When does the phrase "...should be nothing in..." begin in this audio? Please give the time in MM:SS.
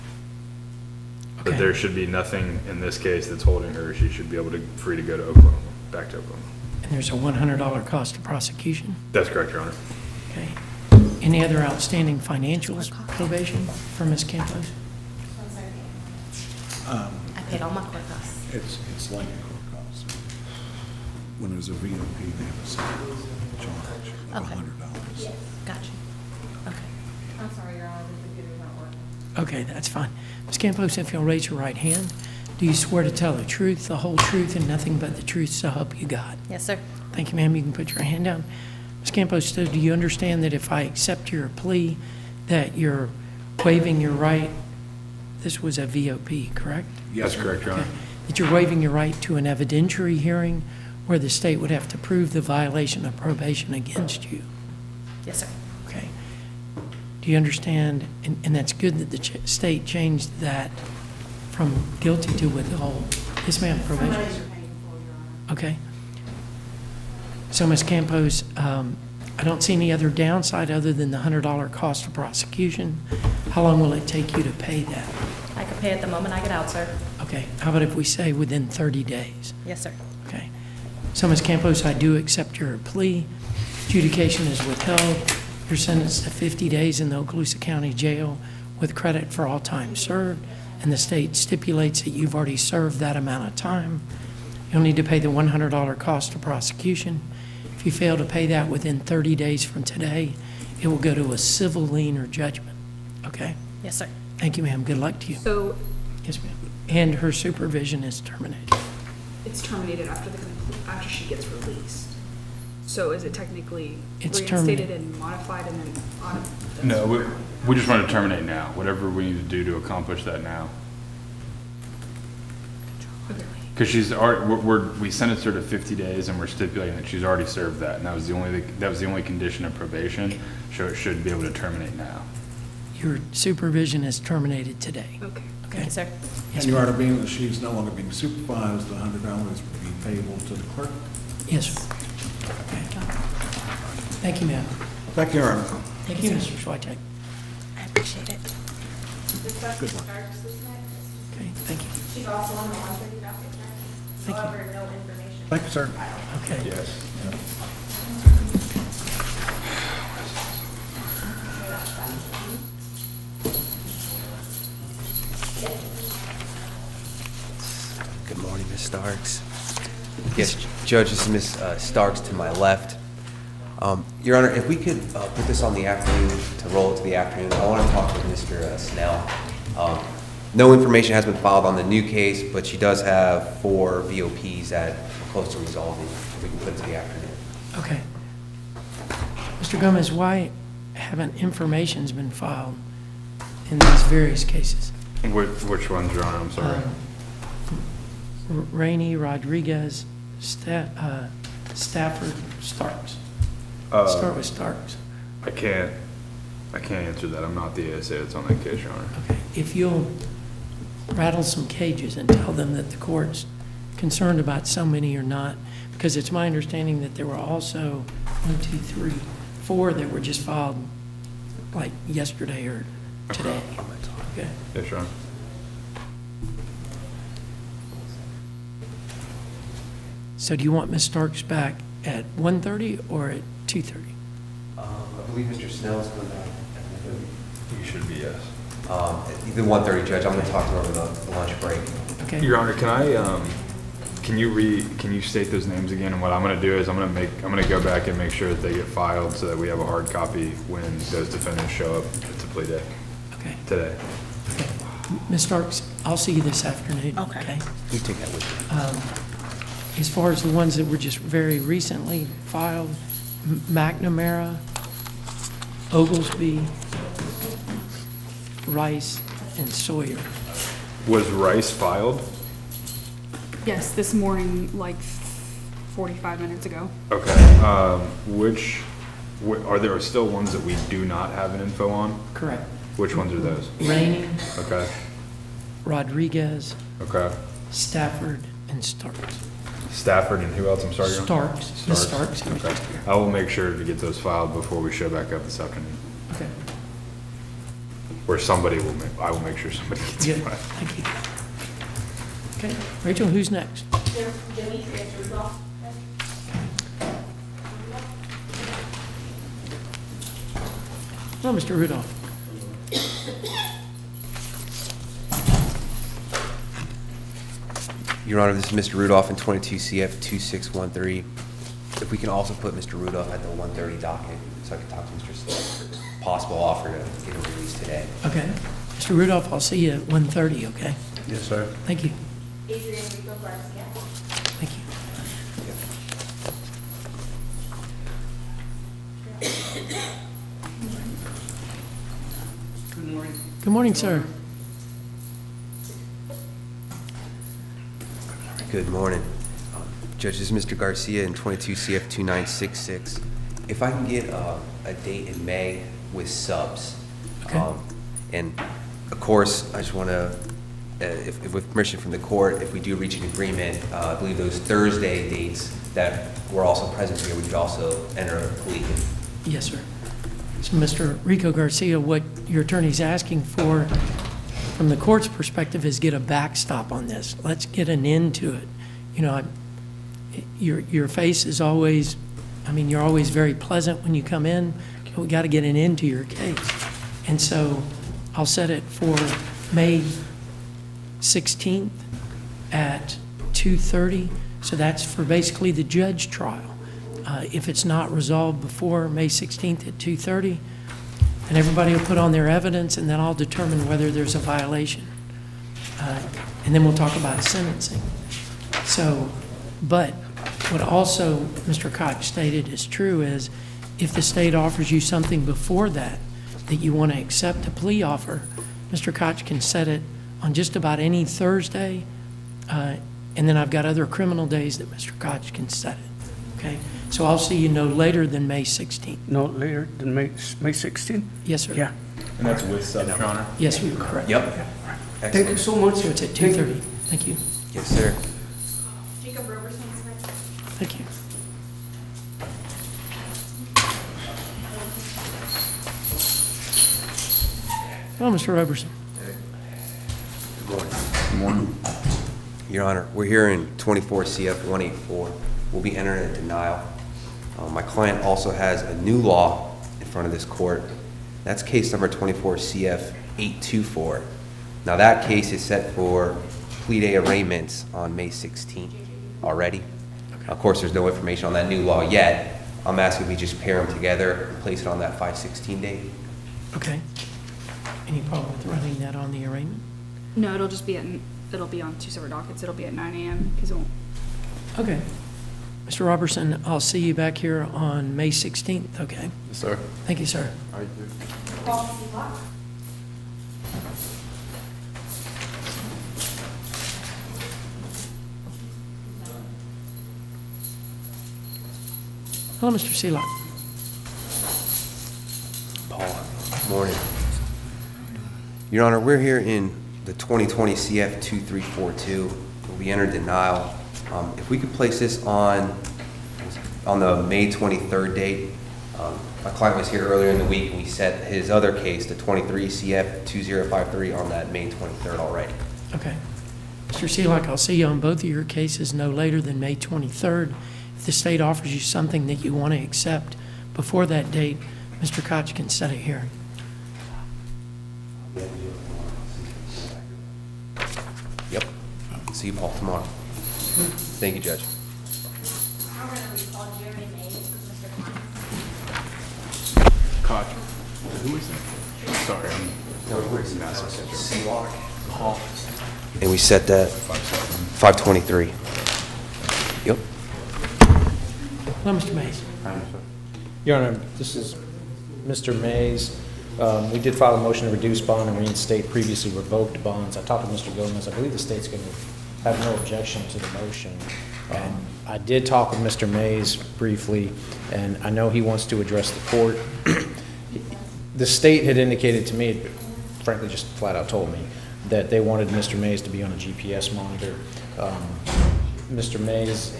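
00:01.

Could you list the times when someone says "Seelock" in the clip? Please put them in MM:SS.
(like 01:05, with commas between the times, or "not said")
08:22, 08:47.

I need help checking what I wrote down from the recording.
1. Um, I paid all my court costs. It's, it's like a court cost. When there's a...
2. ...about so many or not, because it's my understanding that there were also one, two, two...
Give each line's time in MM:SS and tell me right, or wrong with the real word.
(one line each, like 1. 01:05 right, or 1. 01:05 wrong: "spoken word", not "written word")
1. 00:16 right
2. 03:34 wrong: "three", not "two".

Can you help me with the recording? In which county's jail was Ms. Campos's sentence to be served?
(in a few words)
Okaloosa County.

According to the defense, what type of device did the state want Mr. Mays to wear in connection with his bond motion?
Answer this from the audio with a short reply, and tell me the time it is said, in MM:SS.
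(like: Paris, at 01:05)
GPS monitor, at 09:46.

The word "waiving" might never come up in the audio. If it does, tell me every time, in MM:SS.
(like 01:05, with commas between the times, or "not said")
00:43, 00:48.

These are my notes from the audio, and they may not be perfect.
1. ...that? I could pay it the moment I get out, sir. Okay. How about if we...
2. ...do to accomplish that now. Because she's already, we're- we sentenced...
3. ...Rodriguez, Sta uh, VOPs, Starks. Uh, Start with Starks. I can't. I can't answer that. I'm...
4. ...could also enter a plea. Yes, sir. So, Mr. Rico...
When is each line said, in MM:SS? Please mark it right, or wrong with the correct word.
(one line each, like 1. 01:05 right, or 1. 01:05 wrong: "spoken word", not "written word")
1. 01:14 right
2. 01:59 right
3. 03:19 wrong: "Stafford", not "VOPs"
4. 06:07 right.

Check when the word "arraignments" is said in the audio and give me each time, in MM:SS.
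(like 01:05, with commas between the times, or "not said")
07:47, 07:59.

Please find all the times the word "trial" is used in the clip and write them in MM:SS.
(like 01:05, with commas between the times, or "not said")
06:36.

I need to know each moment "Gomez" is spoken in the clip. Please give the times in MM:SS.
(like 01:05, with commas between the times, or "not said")
03:09, 09:30.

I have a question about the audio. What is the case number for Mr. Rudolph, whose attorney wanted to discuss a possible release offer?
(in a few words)
22 CF 2613.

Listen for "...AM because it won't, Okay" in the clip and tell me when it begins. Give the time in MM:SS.
08:03.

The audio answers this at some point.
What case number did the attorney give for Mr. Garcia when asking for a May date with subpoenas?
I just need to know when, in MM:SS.
05:51.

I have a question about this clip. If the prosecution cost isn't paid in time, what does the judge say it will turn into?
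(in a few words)
civil lien or judgment.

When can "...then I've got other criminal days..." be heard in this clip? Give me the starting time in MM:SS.
07:03.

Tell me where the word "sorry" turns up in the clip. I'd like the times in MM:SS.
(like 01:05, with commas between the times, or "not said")
00:27, 03:16, 04:50, 09:12.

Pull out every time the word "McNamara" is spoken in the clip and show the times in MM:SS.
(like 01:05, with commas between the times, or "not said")
04:23.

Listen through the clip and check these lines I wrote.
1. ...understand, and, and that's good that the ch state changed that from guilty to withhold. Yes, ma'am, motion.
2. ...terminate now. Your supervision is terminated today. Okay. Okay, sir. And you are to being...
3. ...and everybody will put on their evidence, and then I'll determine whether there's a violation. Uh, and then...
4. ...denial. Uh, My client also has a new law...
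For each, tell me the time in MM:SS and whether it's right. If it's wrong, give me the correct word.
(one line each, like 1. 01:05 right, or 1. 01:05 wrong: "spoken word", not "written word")
1. 00:57 wrong: "probation", not "motion"
2. 02:11 right
3. 06:41 right
4. 07:36 right.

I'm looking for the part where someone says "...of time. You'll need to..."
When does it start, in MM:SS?
01:33.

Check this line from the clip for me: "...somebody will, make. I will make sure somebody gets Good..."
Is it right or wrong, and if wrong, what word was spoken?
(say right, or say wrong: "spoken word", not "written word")
right.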